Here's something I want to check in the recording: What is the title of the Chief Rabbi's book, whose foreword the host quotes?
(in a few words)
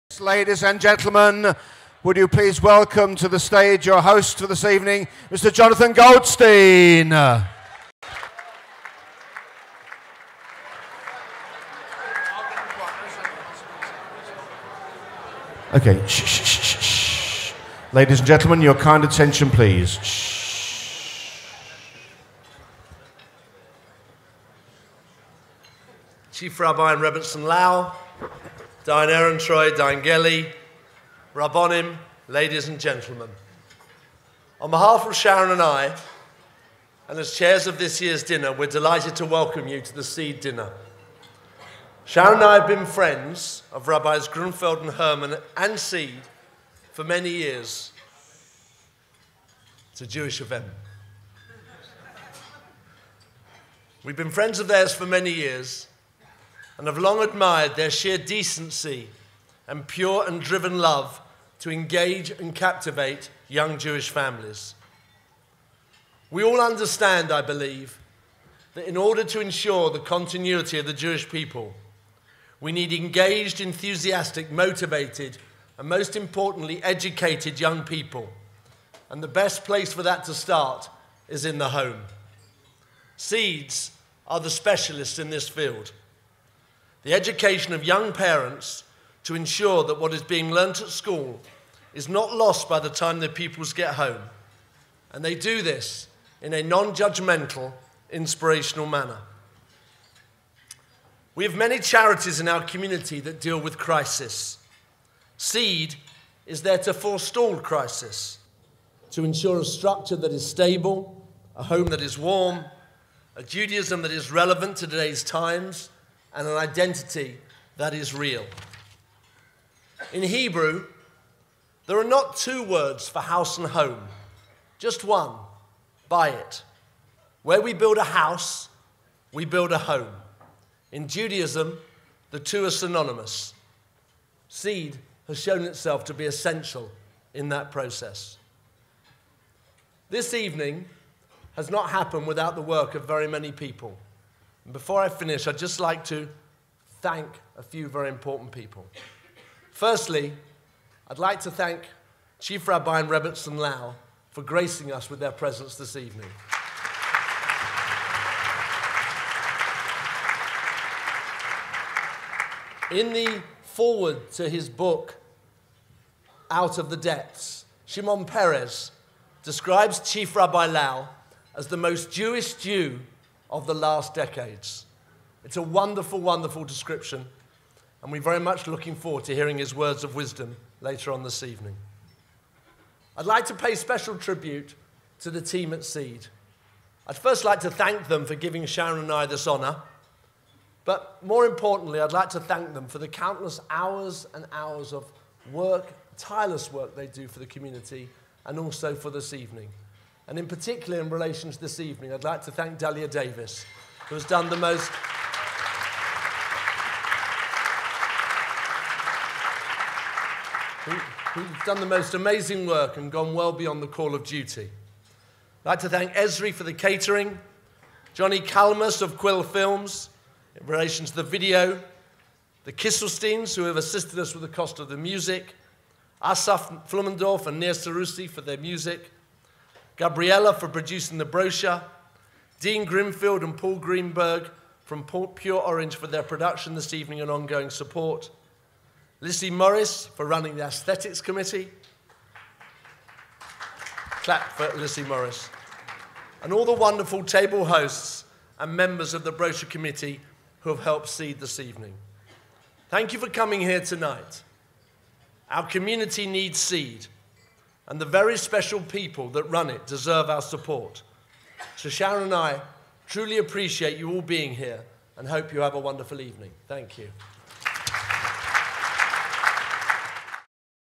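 Out of the Depths.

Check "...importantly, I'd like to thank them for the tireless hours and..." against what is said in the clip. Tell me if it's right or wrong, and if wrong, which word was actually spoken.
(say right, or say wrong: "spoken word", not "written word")
wrong: "countless", not "tireless".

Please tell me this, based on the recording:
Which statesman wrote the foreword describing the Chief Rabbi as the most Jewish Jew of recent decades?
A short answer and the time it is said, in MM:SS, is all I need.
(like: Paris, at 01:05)
Shimon Peres, at 02:47.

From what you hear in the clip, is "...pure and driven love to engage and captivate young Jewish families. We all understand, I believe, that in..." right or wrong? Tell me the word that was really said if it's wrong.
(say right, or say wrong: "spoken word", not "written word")
right.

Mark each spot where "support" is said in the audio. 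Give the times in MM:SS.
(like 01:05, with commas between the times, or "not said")
03:57, 04:20.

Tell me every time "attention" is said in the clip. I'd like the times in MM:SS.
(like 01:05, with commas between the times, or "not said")
00:19.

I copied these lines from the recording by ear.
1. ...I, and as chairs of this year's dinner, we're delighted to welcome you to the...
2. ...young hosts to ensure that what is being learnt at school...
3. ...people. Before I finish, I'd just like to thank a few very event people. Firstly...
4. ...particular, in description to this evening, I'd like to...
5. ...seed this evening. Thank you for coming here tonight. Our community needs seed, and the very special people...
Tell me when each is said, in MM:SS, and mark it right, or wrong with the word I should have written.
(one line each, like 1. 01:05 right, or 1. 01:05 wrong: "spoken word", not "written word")
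1. 00:35 right
2. 01:27 wrong: "parents", not "hosts"
3. 02:23 wrong: "important", not "event"
4. 03:20 wrong: "relation", not "description"
5. 04:11 right.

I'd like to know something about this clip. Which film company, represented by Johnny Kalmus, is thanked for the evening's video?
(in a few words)
Quill Films.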